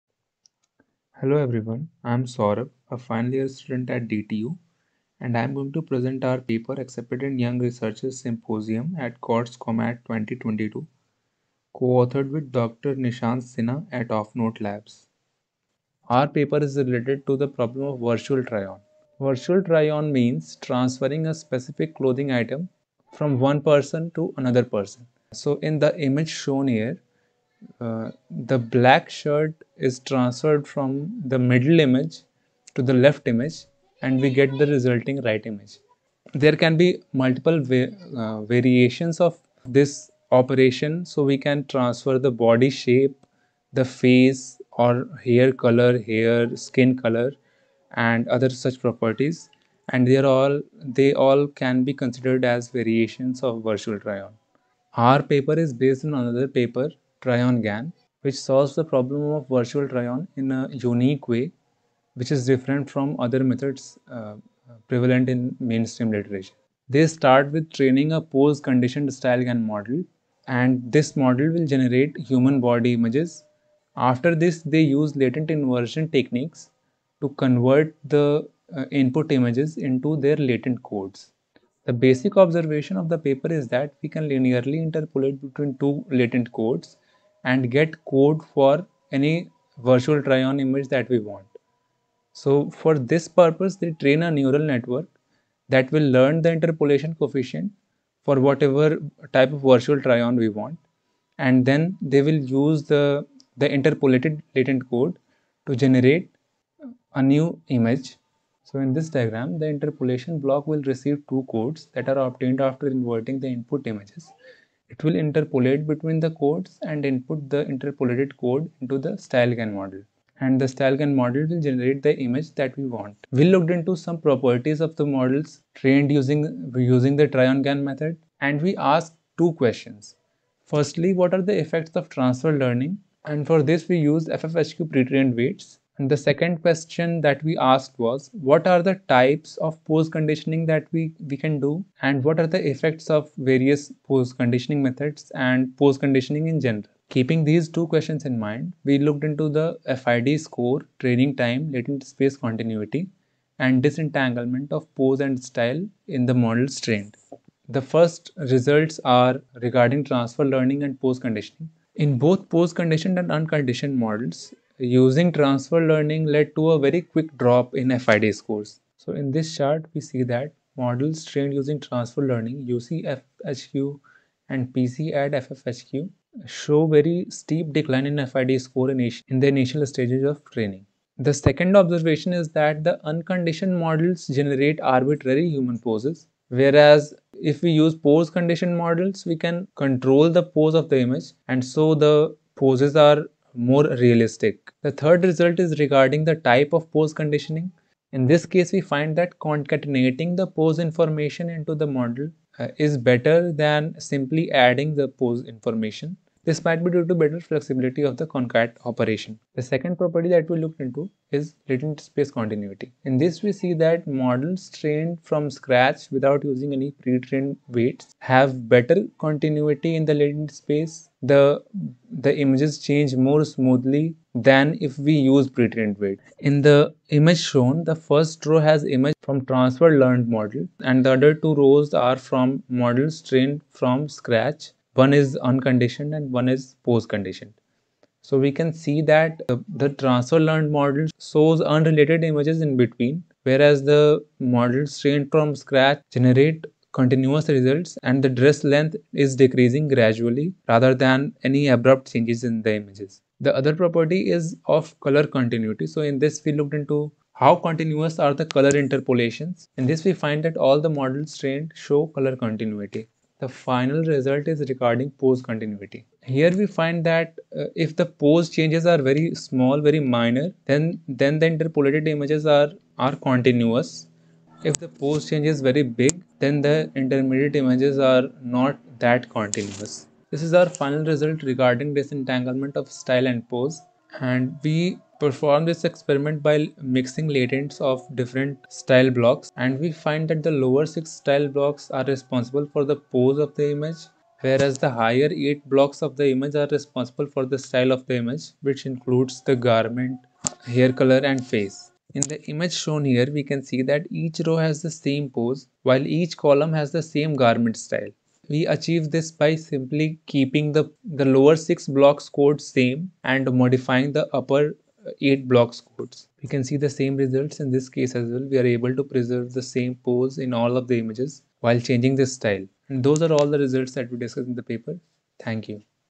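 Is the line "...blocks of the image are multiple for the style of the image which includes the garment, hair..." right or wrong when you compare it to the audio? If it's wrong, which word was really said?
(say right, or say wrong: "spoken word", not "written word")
wrong: "responsible", not "multiple".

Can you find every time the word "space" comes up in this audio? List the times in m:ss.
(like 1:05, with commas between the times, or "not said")
2:32, 3:31, 3:40.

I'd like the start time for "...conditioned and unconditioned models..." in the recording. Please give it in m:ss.
2:42.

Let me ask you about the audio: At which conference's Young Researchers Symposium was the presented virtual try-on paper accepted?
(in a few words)
CODS-COMAD 2022.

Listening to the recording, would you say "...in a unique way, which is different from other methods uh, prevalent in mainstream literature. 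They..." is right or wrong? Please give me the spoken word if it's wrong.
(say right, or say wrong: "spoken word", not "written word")
right.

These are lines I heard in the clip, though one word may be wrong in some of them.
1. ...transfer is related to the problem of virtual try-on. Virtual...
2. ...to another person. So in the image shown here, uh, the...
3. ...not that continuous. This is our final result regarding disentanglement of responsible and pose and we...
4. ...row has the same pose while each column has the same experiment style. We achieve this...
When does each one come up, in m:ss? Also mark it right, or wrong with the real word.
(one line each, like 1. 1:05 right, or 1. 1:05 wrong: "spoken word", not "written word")
1. 0:16 wrong: "paper", not "transfer"
2. 0:24 right
3. 4:38 wrong: "style", not "responsible"
4. 5:04 wrong: "garment", not "experiment".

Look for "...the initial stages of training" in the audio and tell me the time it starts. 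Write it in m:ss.
2:59.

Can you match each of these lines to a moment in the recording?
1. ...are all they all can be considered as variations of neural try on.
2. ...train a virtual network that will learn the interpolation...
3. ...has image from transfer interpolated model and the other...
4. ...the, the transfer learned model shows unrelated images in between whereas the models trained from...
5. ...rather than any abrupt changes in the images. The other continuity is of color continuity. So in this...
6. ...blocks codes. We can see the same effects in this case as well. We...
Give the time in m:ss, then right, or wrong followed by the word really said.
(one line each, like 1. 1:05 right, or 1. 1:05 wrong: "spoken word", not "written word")
1. 0:50 wrong: "virtual", not "neural"
2. 1:33 wrong: "neural", not "virtual"
3. 3:48 wrong: "learned", not "interpolated"
4. 3:59 right
5. 4:10 wrong: "property", not "continuity"
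6. 5:15 wrong: "results", not "effects".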